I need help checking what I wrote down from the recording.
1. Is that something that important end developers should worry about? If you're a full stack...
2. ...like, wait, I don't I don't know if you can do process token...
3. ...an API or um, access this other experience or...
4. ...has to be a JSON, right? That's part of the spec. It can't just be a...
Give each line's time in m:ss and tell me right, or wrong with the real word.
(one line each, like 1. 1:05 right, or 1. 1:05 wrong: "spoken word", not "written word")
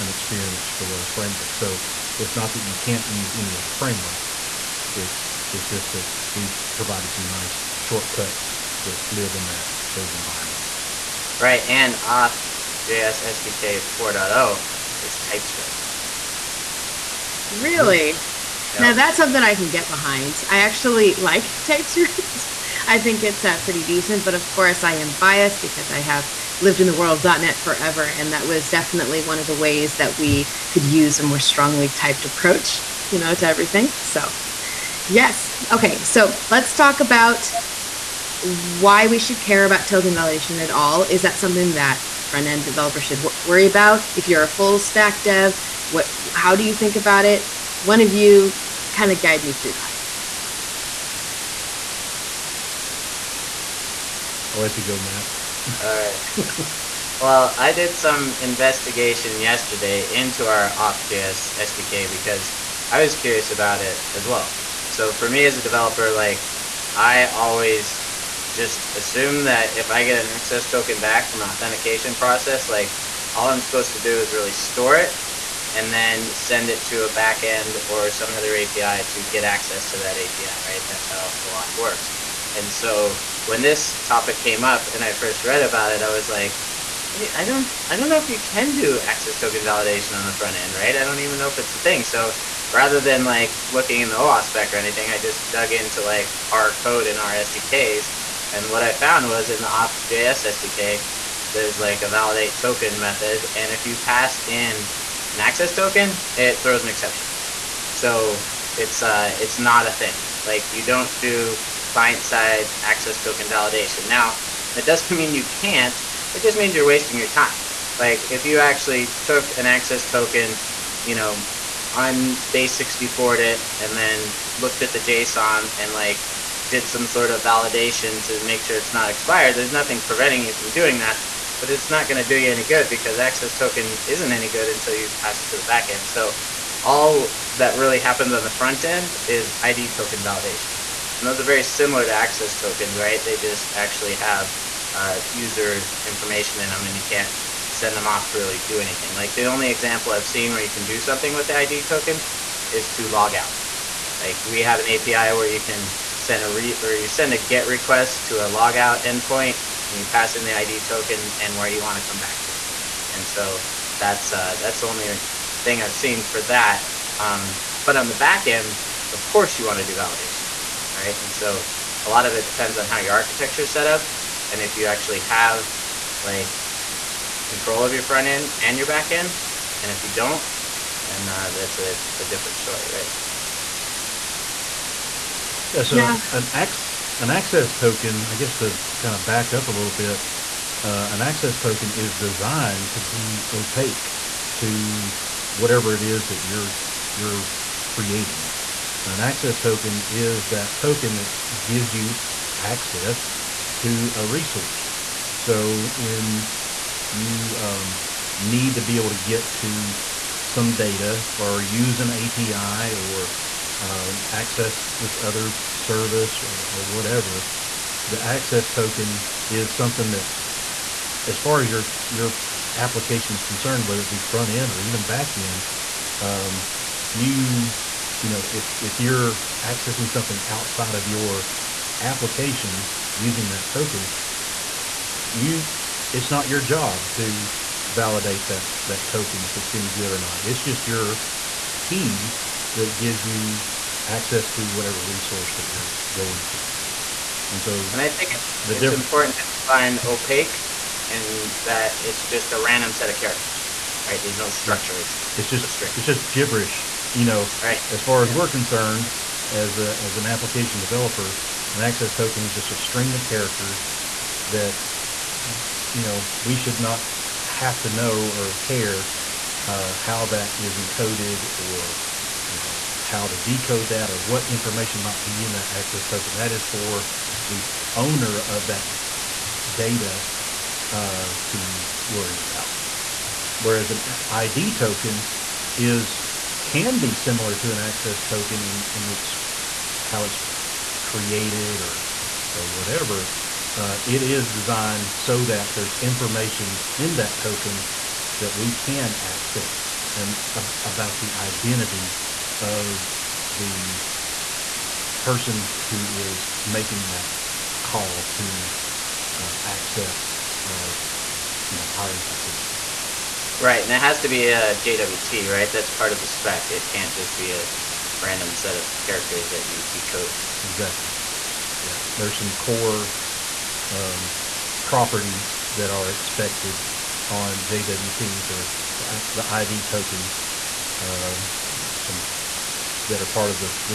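1. 0:41 wrong: "front", not "important"
2. 1:26 wrong: "access", not "process"
3. 3:32 wrong: "service", not "experience"
4. 5:13 wrong: "JWT", not "JSON".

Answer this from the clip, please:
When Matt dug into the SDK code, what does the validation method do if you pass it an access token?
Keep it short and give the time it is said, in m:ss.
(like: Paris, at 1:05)
throws an exception, at 1:46.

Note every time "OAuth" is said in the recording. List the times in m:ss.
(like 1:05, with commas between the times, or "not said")
1:21, 1:34.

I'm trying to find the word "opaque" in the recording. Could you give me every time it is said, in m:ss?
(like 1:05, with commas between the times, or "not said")
3:13, 4:09.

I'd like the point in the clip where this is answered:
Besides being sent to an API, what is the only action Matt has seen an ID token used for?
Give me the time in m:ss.
2:33.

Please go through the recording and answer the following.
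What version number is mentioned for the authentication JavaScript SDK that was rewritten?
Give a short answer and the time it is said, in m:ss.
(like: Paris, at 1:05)
4.0, at 0:13.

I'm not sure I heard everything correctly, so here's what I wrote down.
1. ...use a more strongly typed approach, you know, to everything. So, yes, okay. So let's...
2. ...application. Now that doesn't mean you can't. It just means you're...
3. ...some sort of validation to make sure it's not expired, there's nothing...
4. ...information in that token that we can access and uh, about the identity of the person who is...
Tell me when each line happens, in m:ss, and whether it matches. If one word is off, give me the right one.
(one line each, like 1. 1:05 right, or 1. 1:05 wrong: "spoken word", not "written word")
1. 0:30 right
2. 1:53 wrong: "validation", not "application"
3. 2:06 right
4. 4:55 right.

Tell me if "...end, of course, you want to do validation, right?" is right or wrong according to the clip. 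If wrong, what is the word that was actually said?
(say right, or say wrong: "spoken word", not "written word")
right.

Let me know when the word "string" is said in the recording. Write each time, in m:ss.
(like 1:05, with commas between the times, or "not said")
4:15, 4:22.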